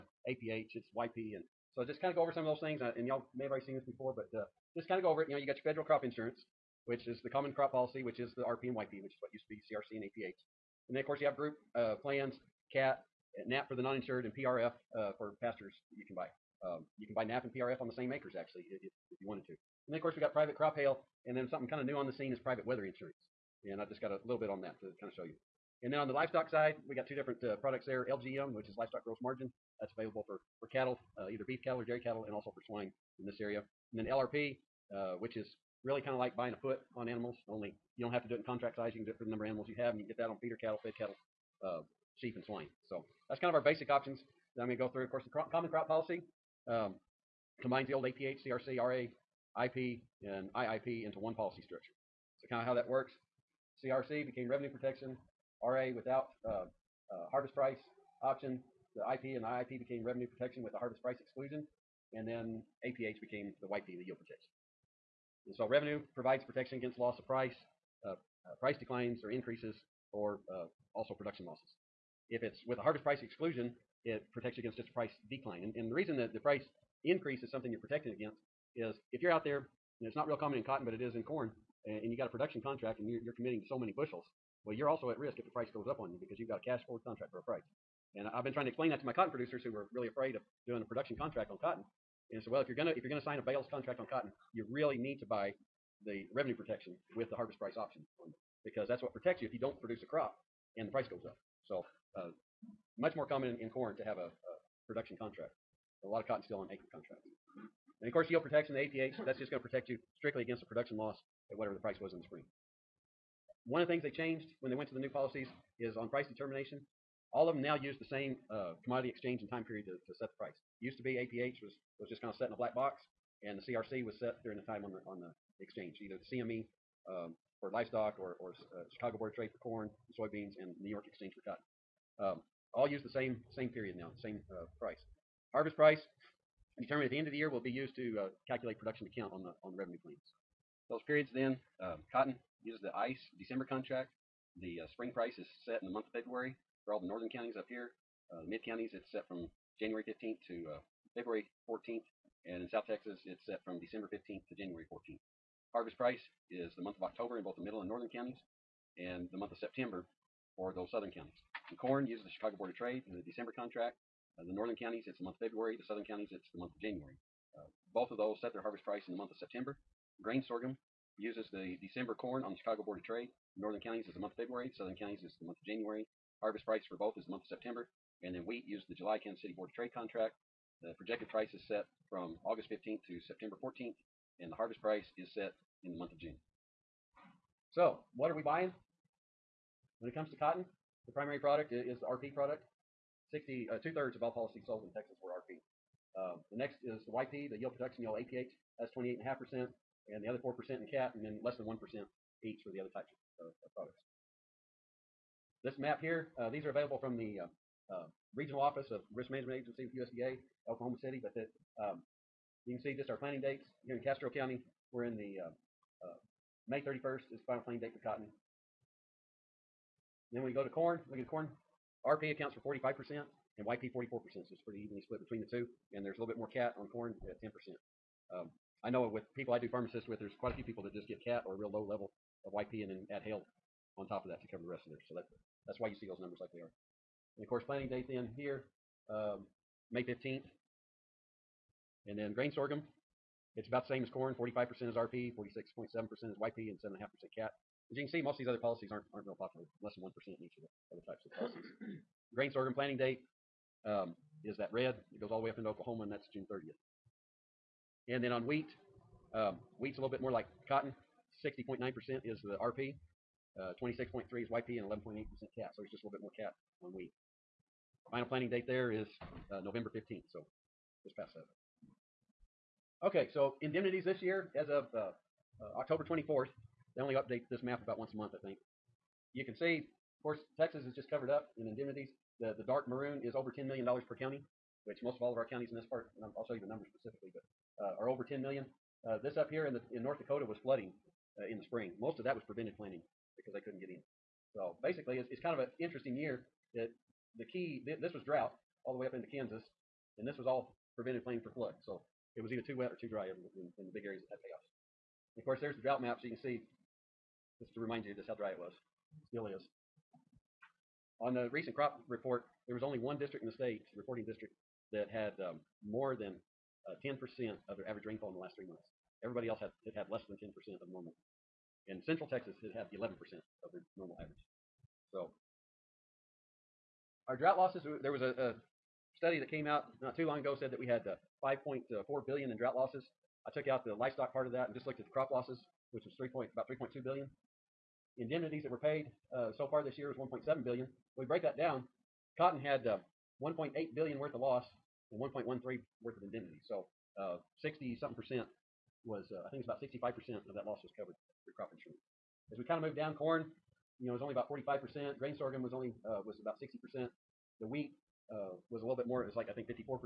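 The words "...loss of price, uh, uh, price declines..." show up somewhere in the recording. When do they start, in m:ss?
1:06.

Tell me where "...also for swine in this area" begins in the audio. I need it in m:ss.
0:32.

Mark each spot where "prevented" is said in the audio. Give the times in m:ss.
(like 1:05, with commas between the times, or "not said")
4:52, 5:00.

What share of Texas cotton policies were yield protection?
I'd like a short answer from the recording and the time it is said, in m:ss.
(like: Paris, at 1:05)
28.5%, at 3:18.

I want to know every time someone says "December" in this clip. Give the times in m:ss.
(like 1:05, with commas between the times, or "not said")
2:23, 2:33, 2:43, 2:51.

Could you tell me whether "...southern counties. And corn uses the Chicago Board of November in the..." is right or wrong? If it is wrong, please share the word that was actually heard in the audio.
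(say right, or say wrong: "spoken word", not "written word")
wrong: "Trade", not "November".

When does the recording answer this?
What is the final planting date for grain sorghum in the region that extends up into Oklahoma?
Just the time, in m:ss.
4:16.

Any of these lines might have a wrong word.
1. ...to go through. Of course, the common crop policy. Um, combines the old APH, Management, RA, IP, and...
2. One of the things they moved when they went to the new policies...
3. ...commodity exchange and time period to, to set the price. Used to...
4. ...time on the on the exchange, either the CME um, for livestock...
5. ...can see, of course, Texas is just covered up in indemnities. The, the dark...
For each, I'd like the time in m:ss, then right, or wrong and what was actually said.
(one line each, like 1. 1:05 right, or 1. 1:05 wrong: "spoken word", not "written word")
1. 0:44 wrong: "CRC", not "Management"
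2. 1:53 wrong: "changed", not "moved"
3. 1:58 right
4. 2:04 right
5. 4:39 right.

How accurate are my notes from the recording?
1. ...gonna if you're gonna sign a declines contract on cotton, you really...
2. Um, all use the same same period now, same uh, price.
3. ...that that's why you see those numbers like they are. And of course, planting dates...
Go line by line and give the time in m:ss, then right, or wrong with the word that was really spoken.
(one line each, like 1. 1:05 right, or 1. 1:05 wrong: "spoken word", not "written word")
1. 1:32 wrong: "bales", not "declines"
2. 2:12 right
3. 3:55 right.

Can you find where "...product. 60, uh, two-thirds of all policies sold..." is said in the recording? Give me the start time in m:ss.
3:12.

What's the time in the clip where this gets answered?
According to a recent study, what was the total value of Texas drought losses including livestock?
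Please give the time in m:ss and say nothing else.
5:31.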